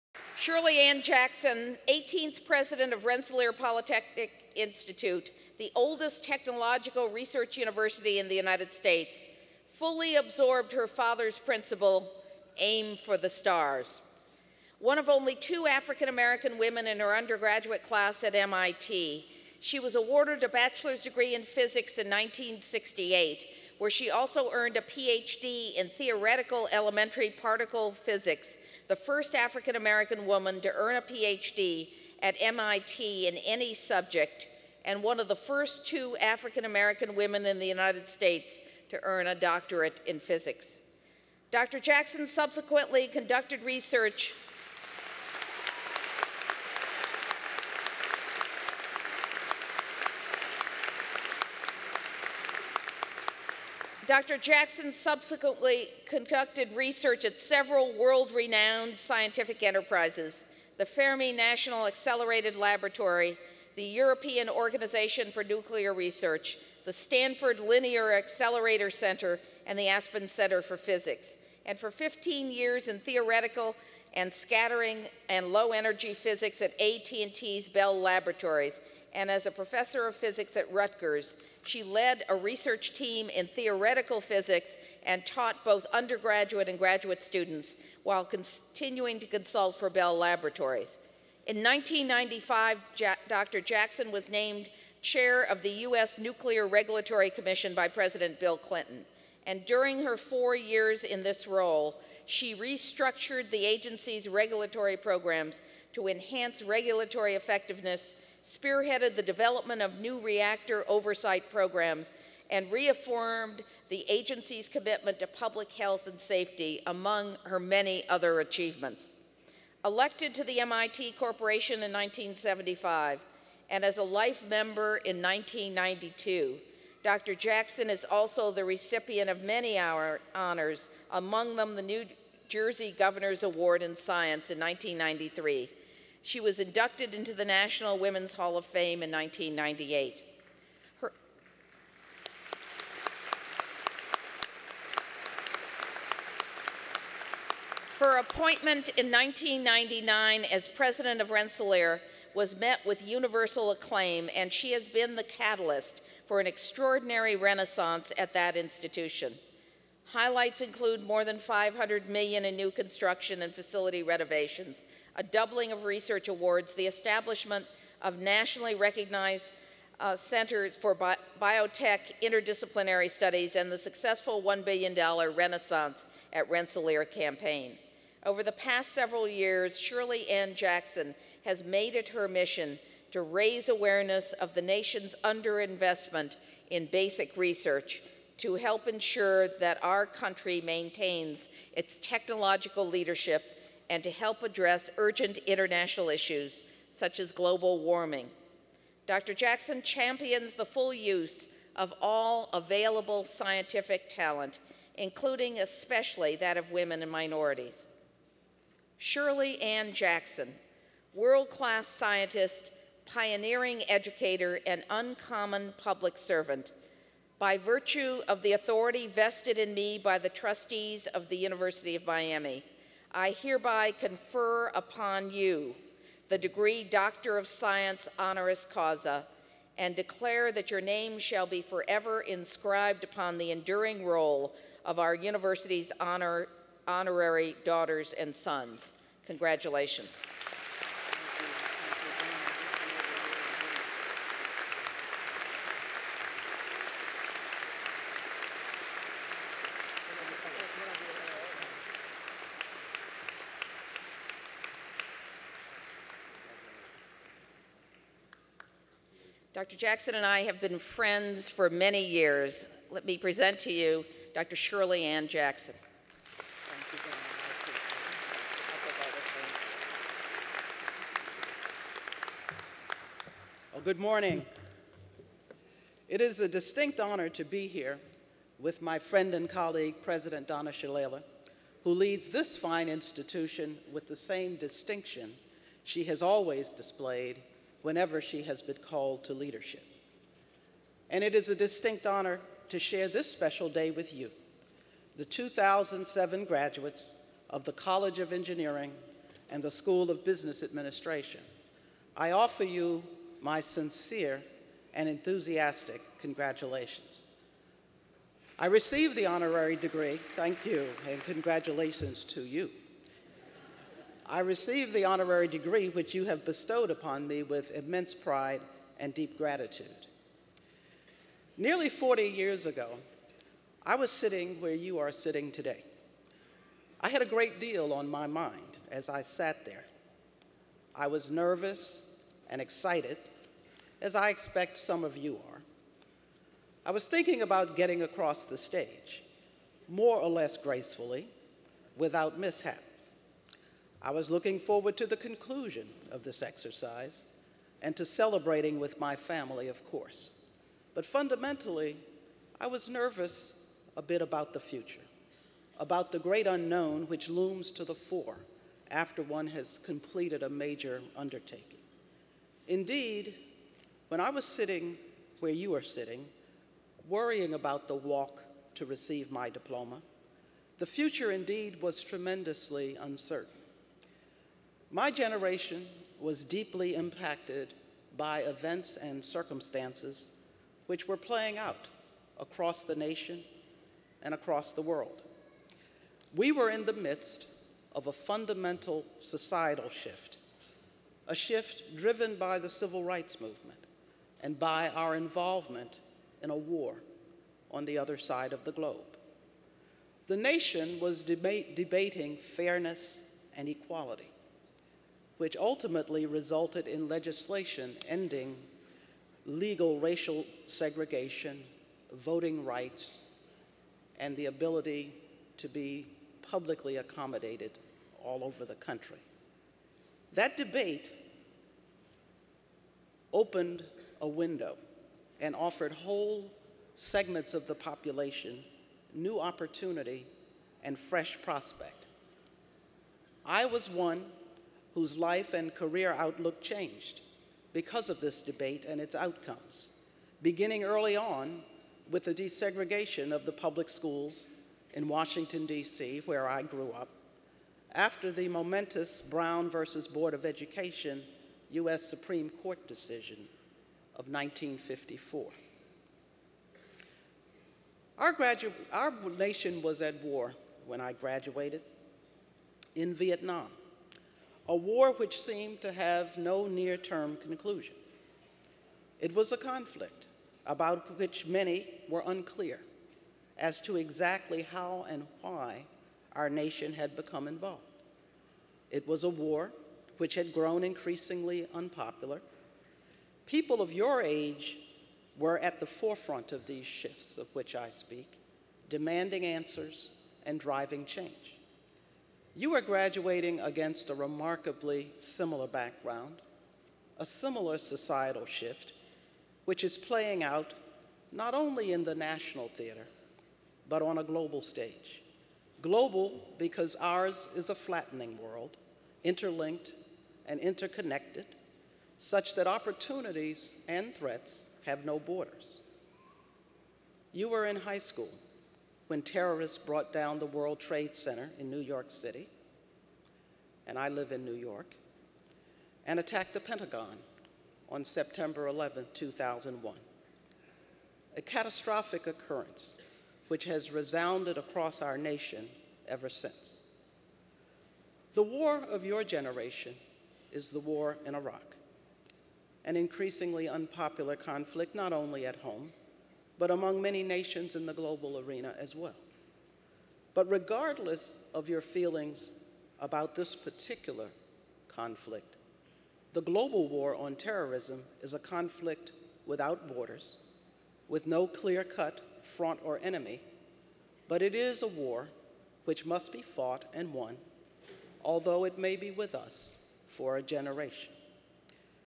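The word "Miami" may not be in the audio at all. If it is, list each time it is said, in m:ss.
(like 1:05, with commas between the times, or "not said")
3:42.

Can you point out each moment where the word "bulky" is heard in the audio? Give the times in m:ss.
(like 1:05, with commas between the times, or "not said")
not said.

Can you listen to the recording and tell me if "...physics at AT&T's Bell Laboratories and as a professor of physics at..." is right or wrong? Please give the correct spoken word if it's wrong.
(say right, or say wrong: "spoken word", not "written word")
right.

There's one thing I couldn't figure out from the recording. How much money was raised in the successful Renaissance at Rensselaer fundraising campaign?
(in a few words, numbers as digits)
$1 billion.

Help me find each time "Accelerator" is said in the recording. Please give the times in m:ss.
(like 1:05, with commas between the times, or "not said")
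1:01, 1:08.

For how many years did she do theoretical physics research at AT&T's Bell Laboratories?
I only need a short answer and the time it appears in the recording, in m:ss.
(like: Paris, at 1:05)
15 years, at 1:11.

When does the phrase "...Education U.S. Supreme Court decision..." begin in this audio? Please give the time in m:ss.
7:30.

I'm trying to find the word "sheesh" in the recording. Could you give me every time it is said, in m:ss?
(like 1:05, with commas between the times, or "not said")
not said.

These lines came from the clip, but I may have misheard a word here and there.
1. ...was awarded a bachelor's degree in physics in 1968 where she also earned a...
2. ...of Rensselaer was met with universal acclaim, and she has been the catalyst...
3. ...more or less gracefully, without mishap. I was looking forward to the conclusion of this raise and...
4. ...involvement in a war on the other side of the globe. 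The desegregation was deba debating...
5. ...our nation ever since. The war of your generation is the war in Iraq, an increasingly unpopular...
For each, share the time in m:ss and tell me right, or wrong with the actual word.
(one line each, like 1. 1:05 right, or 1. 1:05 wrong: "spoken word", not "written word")
1. 0:19 right
2. 2:31 right
3. 5:39 wrong: "exercise", not "raise"
4. 6:35 wrong: "nation", not "desegregation"
5. 8:55 right.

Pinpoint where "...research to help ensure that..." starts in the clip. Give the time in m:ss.
3:07.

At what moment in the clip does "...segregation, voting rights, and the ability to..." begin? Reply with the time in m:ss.
6:50.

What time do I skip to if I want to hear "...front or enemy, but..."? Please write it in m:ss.
9:22.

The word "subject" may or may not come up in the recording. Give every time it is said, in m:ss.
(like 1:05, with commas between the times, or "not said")
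0:33.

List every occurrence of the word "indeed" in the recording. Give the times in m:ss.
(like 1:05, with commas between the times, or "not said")
6:02, 6:11.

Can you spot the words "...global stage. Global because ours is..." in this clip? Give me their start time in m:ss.
8:24.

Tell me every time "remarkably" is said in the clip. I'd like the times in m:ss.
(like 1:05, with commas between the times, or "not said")
8:14.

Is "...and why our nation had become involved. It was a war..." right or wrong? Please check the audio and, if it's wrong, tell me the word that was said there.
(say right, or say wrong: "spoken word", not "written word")
right.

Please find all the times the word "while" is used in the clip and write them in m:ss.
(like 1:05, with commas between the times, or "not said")
1:28.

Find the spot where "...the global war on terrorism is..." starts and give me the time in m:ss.
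9:16.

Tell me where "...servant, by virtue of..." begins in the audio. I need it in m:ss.
3:36.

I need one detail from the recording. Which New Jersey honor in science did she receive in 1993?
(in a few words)
Governor's Award in Science.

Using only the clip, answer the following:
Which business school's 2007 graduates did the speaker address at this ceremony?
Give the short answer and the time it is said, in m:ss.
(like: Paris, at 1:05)
School of Business Administration, at 4:59.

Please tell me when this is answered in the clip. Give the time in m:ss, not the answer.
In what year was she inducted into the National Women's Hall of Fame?
2:19.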